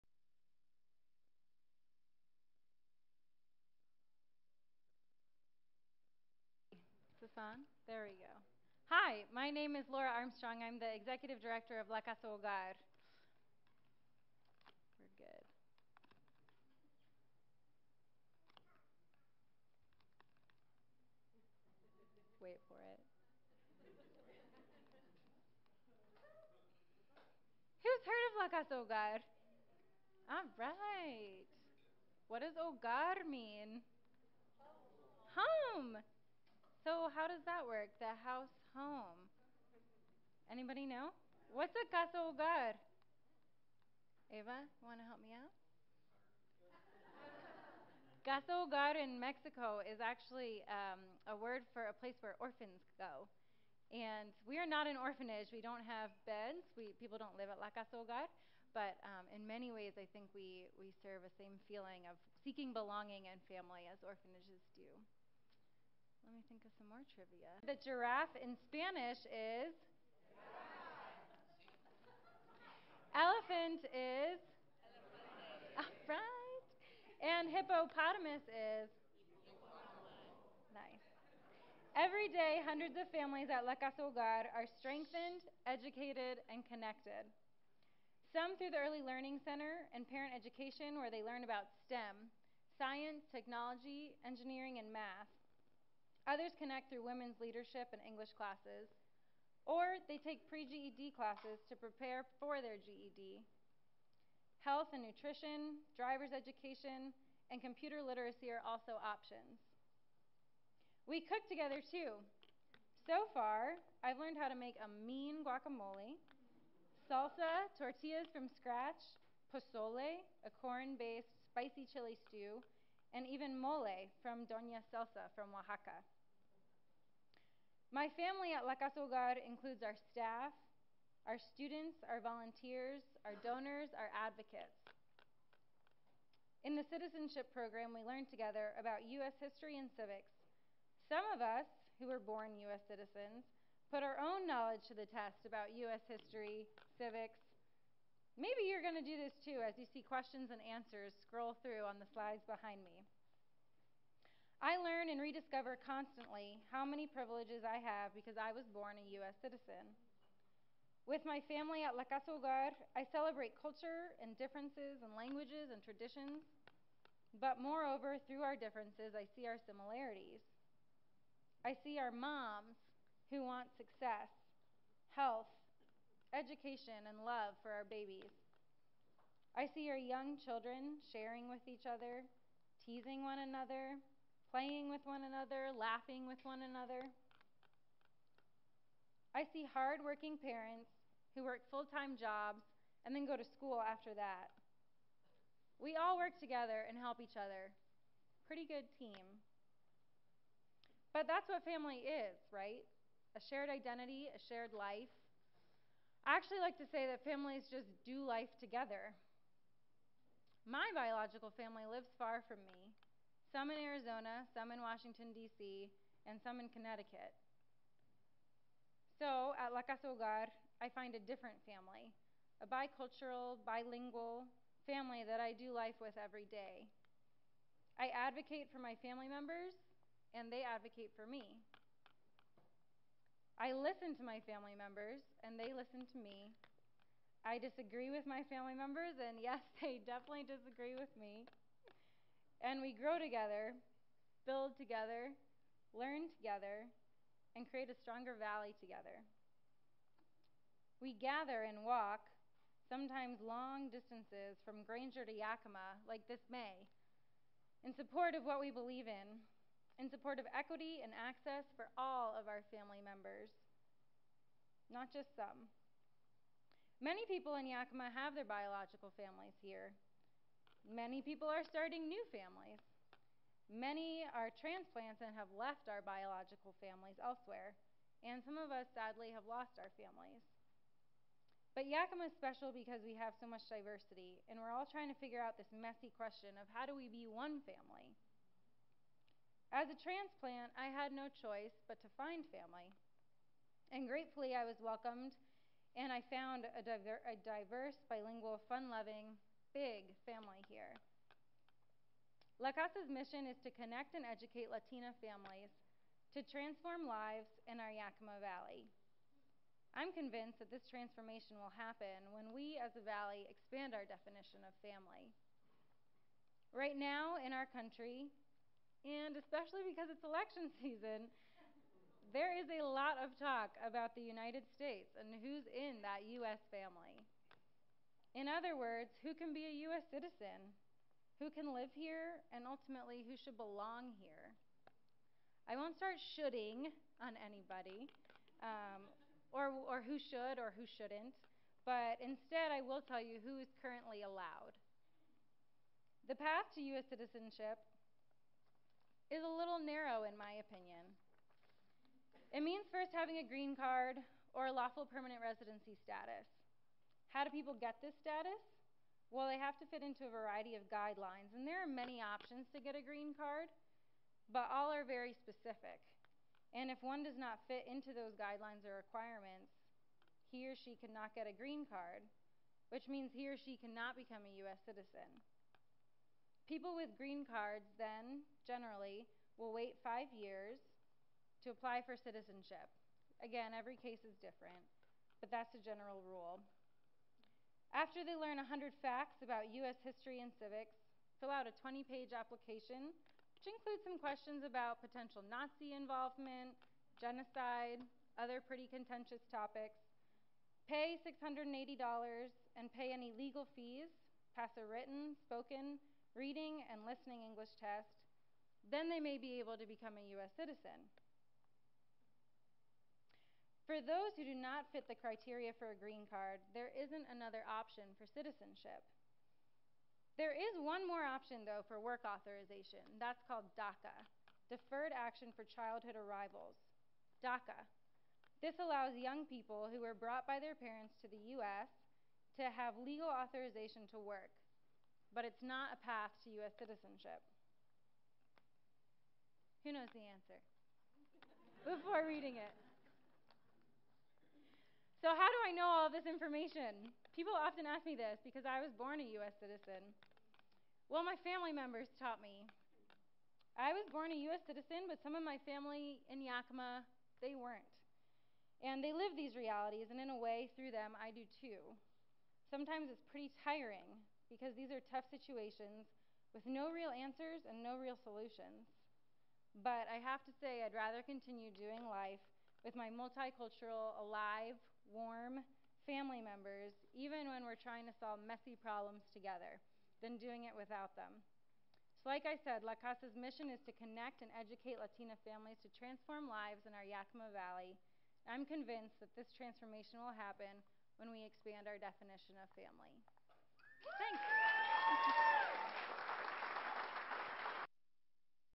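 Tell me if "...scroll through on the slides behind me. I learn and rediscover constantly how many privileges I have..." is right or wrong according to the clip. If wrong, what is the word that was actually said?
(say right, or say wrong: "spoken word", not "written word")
right.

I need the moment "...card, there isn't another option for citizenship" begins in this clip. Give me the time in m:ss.
6:56.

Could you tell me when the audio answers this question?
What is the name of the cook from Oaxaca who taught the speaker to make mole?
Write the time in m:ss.
2:04.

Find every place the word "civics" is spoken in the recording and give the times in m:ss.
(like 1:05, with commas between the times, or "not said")
2:19, 2:26, 6:30.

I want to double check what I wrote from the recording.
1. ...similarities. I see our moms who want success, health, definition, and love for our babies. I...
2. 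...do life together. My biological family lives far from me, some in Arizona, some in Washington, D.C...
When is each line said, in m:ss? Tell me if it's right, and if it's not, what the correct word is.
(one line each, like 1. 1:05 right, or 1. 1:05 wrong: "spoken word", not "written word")
1. 2:49 wrong: "education", not "definition"
2. 3:28 right.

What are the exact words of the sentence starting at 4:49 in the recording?
As a transplant, I had no choice but to find family.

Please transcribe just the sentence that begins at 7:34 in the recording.
citizen, but some of my family in Yakima, they weren't.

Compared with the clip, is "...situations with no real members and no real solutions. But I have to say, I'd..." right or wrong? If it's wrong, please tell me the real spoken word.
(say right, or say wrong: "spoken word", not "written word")
wrong: "answers", not "members".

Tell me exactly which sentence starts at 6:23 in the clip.
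Again, every case is different, but that's a general rule.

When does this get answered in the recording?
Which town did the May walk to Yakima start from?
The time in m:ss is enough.
4:14.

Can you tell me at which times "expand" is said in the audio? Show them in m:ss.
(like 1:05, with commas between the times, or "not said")
5:13, 8:11.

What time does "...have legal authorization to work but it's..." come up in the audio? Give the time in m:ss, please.
7:12.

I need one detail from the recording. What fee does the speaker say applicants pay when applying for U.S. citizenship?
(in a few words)
$680.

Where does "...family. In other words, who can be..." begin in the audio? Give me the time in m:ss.
5:26.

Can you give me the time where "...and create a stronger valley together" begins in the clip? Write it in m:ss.
4:07.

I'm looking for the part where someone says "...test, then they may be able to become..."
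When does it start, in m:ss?
6:47.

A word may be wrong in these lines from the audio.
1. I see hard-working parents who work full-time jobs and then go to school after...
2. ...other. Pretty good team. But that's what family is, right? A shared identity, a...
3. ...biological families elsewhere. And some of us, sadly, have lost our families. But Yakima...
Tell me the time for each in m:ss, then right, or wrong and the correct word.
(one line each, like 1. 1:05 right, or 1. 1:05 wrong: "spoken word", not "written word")
1. 3:09 right
2. 3:17 right
3. 4:36 right.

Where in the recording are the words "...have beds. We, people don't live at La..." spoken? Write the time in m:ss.
0:55.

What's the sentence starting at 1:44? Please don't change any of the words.
Health and nutrition, driver's education, and computer literacy are also options.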